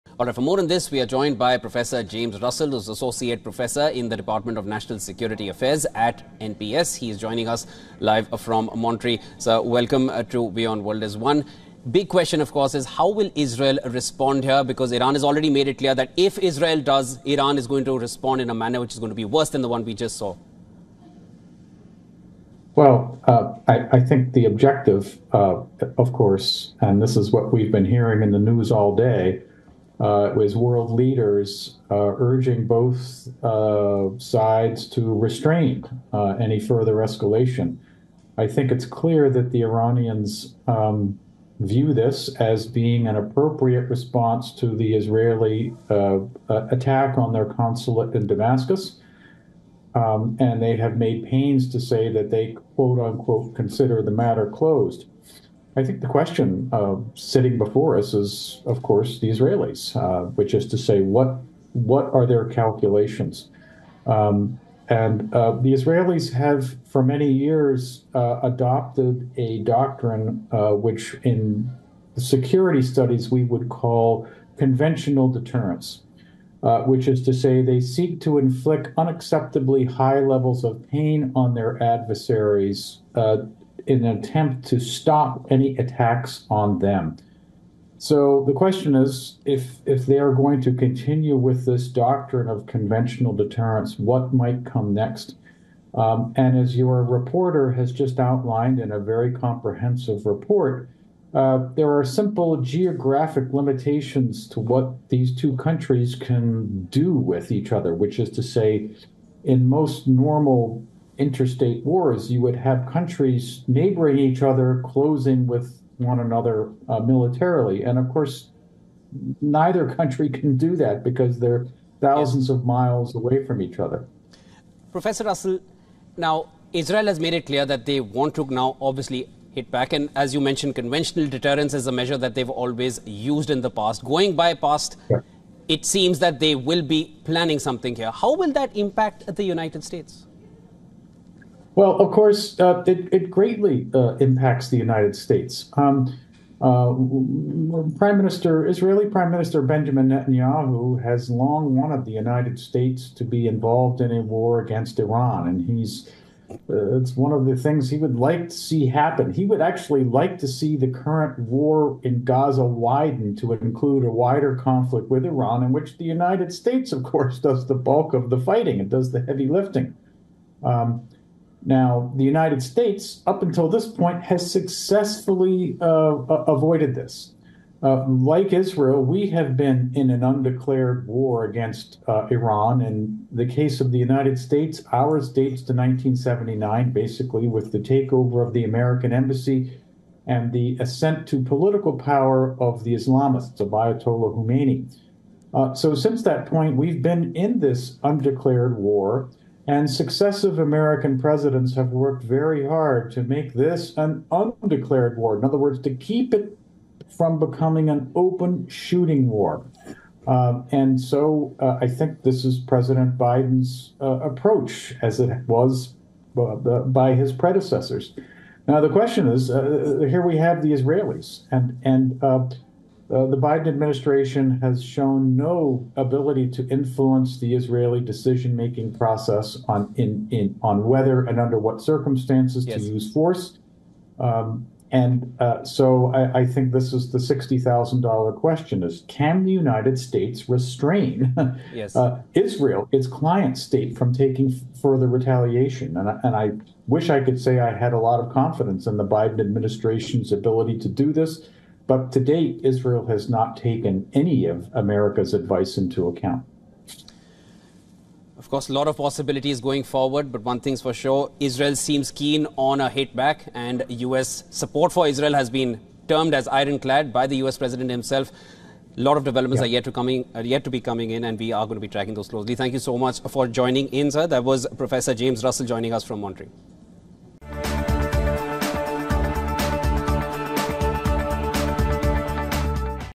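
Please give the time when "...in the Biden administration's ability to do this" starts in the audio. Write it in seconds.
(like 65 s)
248 s.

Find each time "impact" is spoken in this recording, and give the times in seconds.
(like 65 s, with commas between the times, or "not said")
138 s, 144 s.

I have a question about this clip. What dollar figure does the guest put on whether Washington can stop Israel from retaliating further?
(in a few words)
$60,000.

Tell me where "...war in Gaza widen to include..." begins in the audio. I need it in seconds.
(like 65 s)
161 s.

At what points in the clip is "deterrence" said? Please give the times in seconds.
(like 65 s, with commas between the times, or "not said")
75 s, 93 s, 131 s.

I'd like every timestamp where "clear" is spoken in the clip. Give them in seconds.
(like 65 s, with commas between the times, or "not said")
15 s, 38 s, 127 s.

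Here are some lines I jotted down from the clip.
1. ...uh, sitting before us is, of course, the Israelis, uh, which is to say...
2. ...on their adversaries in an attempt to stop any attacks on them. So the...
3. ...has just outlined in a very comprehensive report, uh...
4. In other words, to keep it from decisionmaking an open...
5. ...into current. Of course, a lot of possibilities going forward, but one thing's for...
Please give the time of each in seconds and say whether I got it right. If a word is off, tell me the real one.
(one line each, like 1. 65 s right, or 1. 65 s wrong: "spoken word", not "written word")
1. 56 s right
2. 81 s right
3. 97 s right
4. 205 s wrong: "becoming", not "decisionmaking"
5. 255 s wrong: "account", not "current".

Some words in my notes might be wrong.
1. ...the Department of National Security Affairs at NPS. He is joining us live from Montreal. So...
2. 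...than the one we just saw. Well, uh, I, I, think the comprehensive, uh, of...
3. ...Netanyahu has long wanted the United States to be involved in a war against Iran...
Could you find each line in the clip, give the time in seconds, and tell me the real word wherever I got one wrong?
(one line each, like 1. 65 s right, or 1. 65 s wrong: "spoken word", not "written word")
1. 4 s right
2. 19 s wrong: "objective", not "comprehensive"
3. 150 s right.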